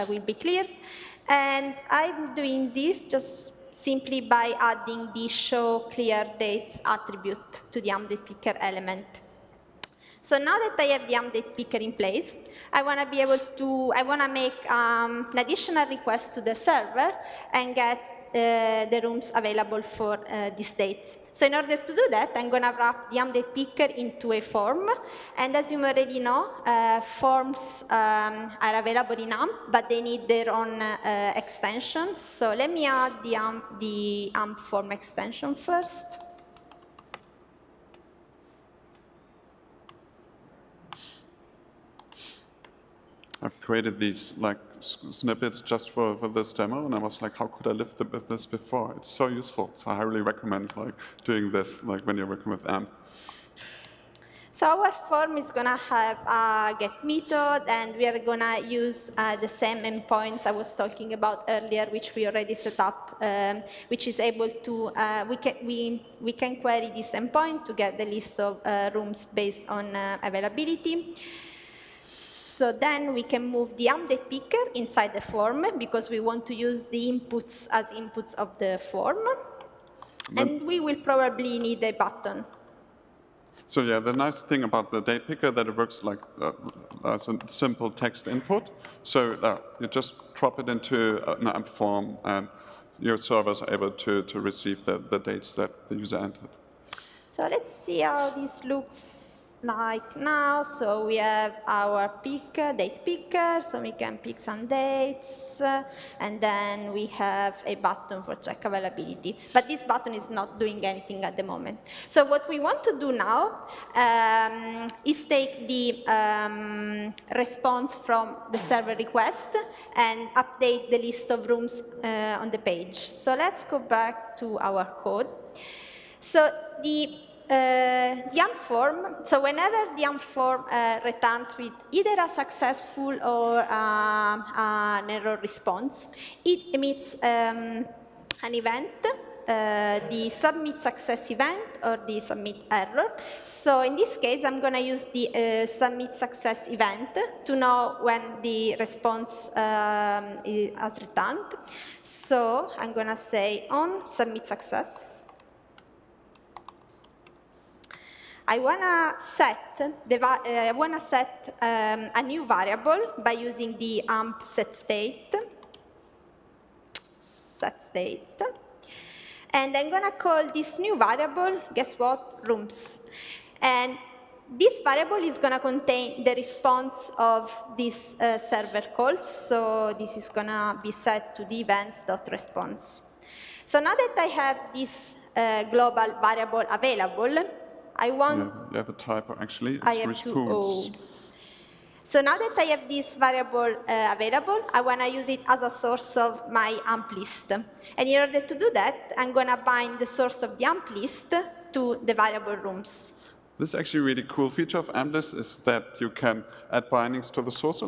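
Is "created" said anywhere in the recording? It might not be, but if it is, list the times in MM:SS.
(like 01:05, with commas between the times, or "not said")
00:43.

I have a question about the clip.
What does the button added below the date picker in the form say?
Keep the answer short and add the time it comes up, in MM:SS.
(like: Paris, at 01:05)
check availability, at 01:48.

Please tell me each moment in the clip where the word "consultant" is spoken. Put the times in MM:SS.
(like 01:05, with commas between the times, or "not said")
not said.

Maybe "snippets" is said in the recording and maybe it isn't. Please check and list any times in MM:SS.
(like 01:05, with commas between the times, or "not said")
00:44.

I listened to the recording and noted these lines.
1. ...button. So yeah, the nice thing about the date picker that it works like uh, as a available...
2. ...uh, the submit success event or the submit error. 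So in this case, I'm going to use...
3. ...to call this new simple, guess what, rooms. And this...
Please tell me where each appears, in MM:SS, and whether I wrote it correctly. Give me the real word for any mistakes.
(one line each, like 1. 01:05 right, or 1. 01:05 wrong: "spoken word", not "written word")
1. 01:21 wrong: "simple", not "available"
2. 02:19 right
3. 02:50 wrong: "variable", not "simple".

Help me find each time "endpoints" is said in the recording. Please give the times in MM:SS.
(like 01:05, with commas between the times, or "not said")
00:59, 01:07.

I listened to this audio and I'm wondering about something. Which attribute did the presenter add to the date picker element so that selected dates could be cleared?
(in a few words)
show clear dates.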